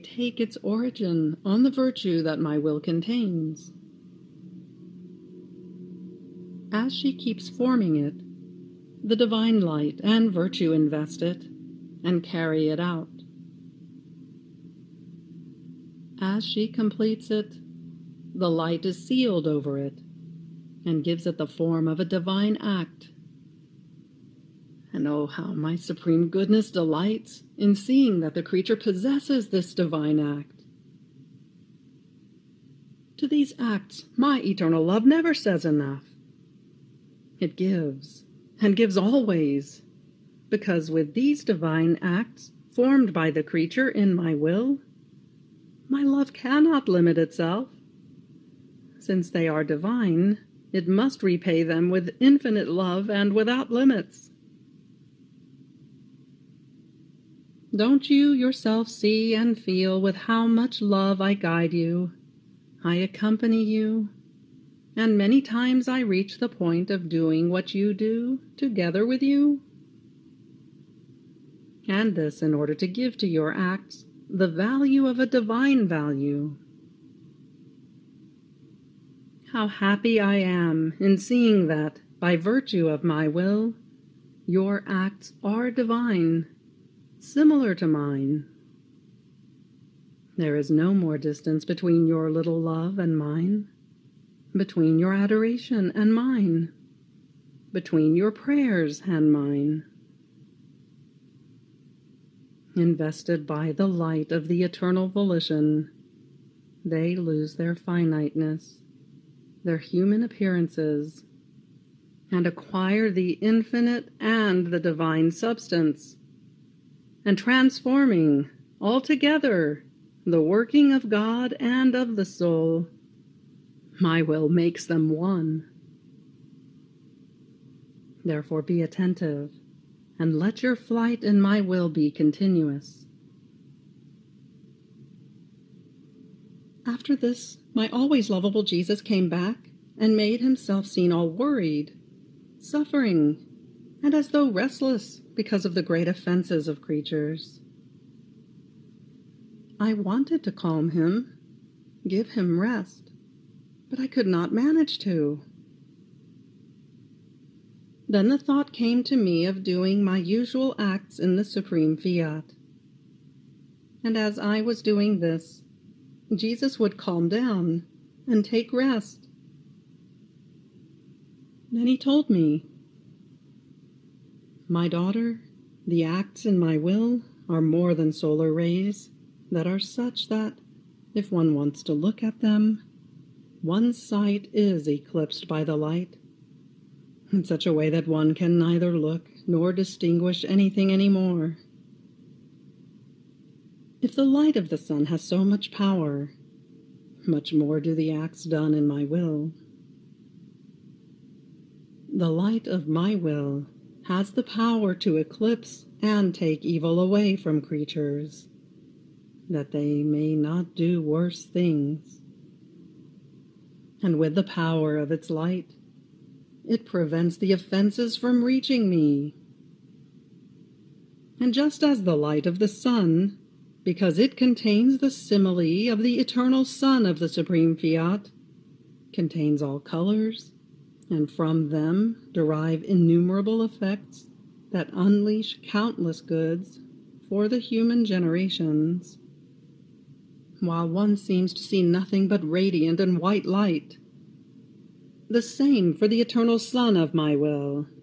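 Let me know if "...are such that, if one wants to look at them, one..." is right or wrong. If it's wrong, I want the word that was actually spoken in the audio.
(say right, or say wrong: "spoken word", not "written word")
right.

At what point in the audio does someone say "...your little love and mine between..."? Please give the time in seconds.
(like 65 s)
92 s.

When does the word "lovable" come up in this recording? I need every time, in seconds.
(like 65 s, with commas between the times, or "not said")
138 s.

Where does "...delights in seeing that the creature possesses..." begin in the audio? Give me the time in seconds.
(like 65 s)
26 s.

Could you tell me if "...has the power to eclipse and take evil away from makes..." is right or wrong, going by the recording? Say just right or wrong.
wrong.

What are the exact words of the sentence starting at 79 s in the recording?
How happy I am in seeing that, by virtue of my will, your acts are divine, similar to mine.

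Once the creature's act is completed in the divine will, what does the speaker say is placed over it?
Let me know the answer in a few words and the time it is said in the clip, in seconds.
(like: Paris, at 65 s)
The light is sealed over it, at 18 s.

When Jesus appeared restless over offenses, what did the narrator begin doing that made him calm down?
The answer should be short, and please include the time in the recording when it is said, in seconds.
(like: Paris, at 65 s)
Usual acts in the supreme fiat, at 160 s.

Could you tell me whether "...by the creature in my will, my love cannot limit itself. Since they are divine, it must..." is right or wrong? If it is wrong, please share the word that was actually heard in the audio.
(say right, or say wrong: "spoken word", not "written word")
right.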